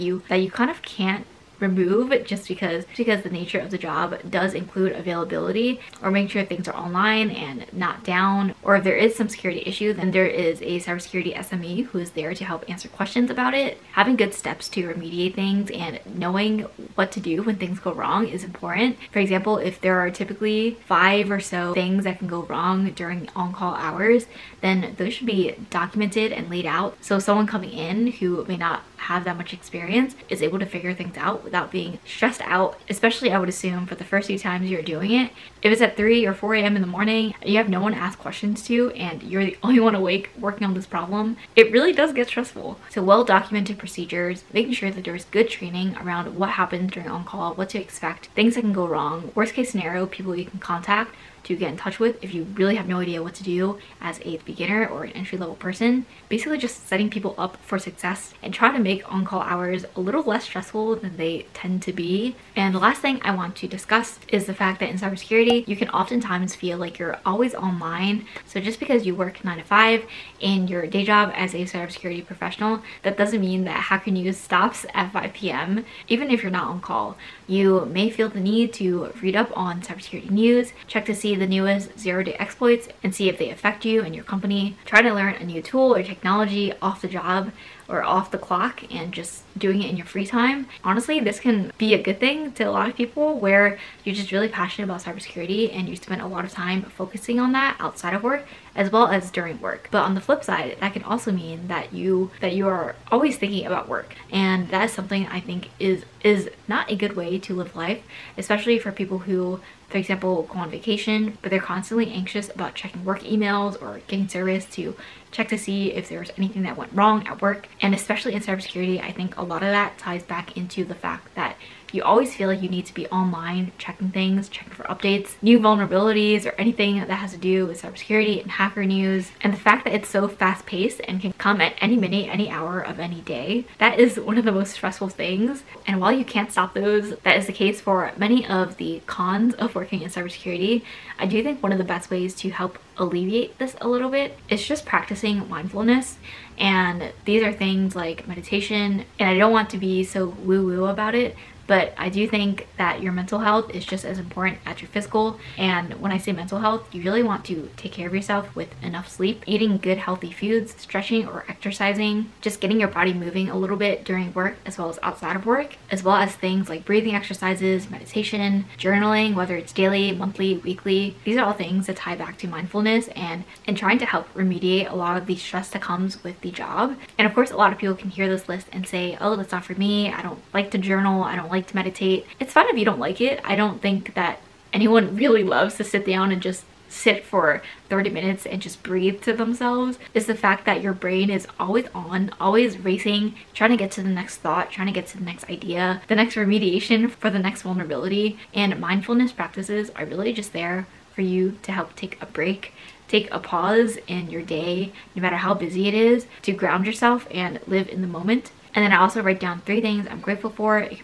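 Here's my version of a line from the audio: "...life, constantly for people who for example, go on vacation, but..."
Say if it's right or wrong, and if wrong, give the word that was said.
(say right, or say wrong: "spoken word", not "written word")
wrong: "especially", not "constantly".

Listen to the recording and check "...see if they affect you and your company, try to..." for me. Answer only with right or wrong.
right.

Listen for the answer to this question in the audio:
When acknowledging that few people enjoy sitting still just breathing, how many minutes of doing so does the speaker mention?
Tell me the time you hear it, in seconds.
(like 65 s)
187 s.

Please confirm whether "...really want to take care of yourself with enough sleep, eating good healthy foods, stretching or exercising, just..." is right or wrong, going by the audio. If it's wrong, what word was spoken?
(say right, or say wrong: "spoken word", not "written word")
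right.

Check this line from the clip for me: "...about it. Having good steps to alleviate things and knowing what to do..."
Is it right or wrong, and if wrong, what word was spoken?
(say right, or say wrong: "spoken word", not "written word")
wrong: "remediate", not "alleviate".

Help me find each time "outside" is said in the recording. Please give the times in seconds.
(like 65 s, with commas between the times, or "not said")
97 s, 165 s.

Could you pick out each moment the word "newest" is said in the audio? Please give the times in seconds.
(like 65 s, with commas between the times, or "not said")
81 s.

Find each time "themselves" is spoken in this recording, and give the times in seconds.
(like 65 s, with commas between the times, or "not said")
189 s.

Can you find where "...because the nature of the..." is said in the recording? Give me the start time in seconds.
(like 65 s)
2 s.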